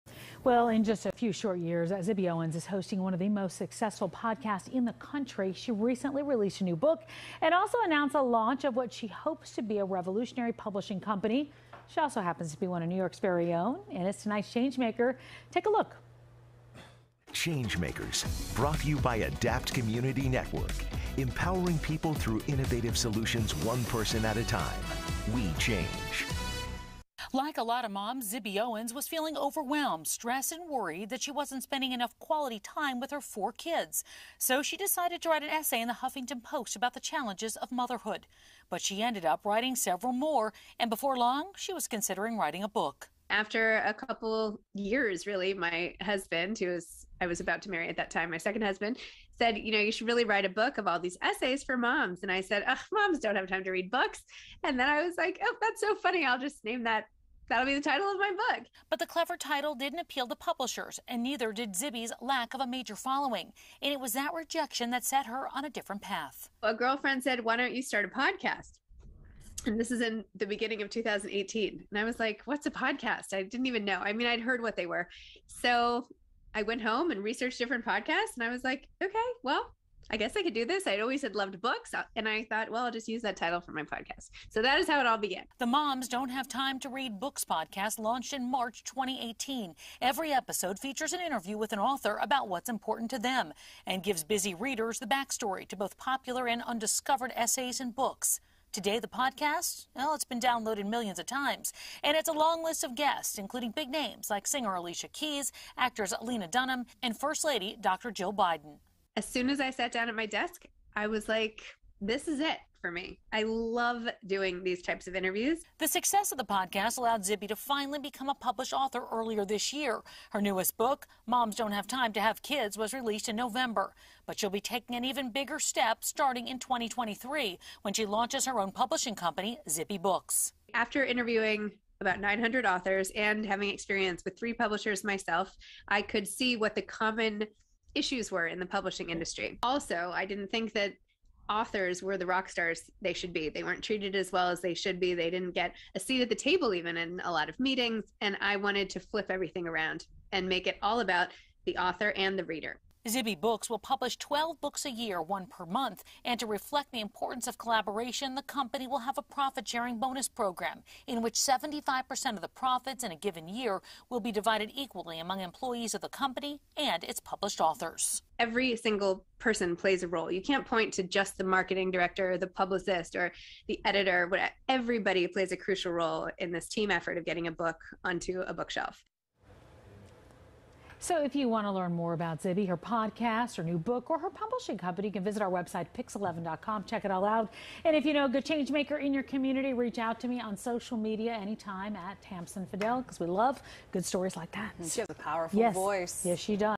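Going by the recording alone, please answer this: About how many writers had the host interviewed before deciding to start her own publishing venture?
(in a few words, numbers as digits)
900.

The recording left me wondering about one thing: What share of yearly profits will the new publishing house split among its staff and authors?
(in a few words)
75%.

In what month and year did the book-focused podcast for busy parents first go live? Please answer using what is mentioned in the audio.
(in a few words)
March 2018.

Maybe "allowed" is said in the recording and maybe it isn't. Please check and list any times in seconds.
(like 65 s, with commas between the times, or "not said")
116 s.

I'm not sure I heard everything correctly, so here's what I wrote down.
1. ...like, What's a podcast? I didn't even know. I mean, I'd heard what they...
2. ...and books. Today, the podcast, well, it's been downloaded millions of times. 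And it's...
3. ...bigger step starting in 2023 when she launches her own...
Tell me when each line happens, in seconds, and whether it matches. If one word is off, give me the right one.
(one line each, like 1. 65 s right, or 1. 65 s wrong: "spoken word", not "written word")
1. 72 s right
2. 97 s right
3. 125 s right.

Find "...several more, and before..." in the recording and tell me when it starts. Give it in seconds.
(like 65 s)
39 s.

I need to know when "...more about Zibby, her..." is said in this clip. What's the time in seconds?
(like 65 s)
181 s.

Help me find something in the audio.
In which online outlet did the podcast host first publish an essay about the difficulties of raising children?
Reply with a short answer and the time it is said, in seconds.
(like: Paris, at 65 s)
Huffington Post, at 35 s.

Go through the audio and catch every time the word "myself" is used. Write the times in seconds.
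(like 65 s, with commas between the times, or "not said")
135 s.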